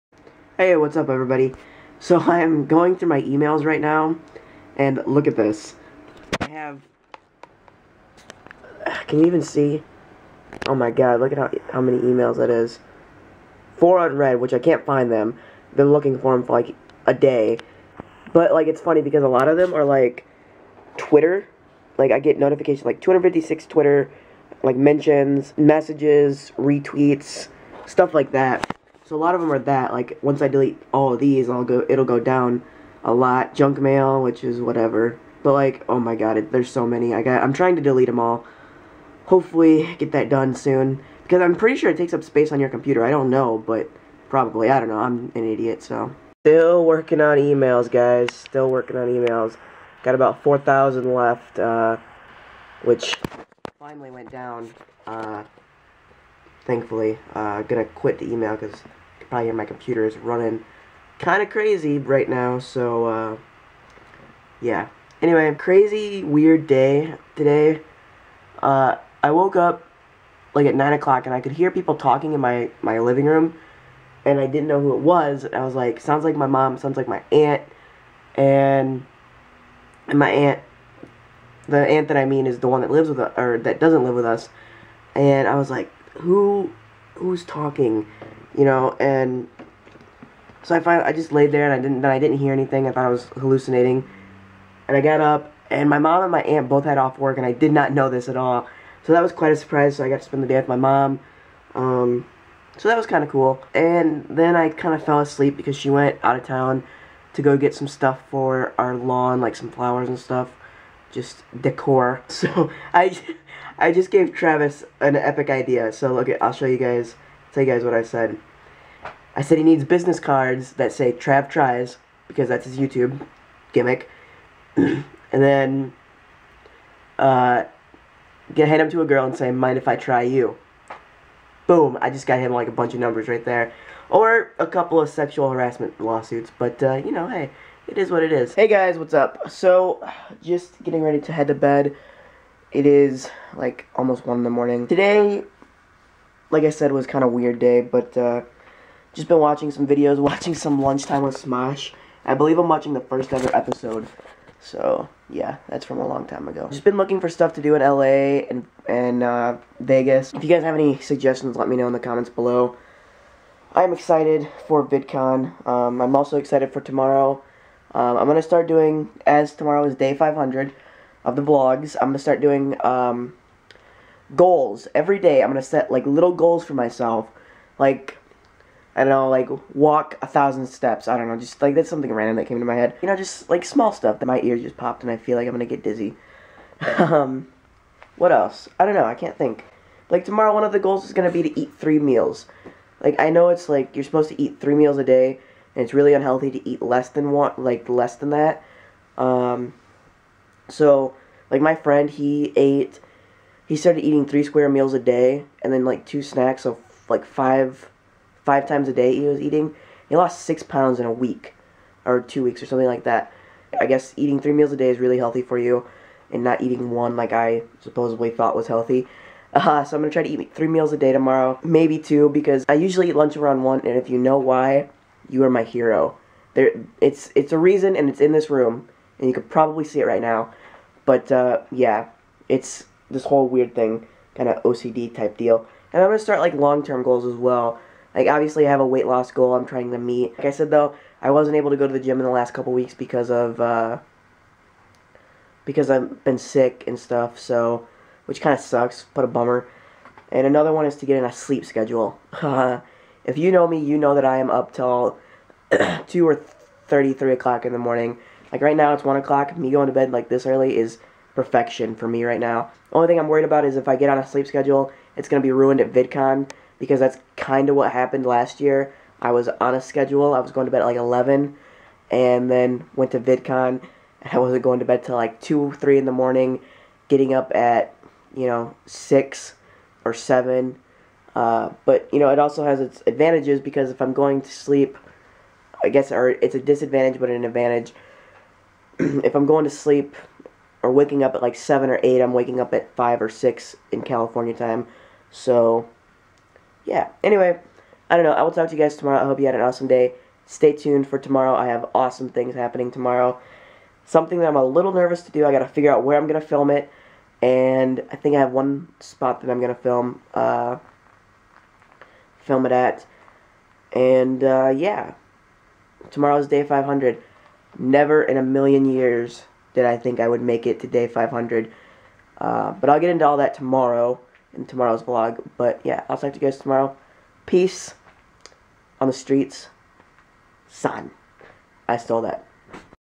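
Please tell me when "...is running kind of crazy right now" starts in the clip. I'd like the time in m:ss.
1:00.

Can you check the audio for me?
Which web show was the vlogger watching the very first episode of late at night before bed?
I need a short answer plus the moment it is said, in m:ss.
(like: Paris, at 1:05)
Lunchtime with Smosh, at 2:30.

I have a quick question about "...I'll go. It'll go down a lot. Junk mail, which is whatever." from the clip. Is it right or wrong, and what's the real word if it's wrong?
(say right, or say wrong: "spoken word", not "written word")
right.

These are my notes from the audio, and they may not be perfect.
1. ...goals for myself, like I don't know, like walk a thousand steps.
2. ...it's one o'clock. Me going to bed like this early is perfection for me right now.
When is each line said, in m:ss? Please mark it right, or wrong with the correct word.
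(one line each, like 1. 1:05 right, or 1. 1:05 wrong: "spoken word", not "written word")
1. 2:56 right
2. 4:18 right.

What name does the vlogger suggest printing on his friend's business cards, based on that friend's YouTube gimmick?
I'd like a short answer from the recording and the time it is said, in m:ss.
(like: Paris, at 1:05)
Trav Tries, at 2:01.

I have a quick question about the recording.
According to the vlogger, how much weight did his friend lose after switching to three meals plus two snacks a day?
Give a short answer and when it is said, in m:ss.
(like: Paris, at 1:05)
6 pounds, at 3:30.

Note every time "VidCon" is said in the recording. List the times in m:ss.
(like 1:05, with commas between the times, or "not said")
2:44, 4:25, 4:33.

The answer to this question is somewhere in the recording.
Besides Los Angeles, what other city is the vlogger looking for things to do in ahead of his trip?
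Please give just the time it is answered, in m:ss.
2:39.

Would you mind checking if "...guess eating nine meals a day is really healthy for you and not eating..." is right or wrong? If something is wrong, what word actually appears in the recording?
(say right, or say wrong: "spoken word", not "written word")
wrong: "three", not "nine".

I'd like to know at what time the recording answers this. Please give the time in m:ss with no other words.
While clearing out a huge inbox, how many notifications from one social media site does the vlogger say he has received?
0:23.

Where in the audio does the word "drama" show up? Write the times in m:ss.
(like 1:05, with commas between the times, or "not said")
not said.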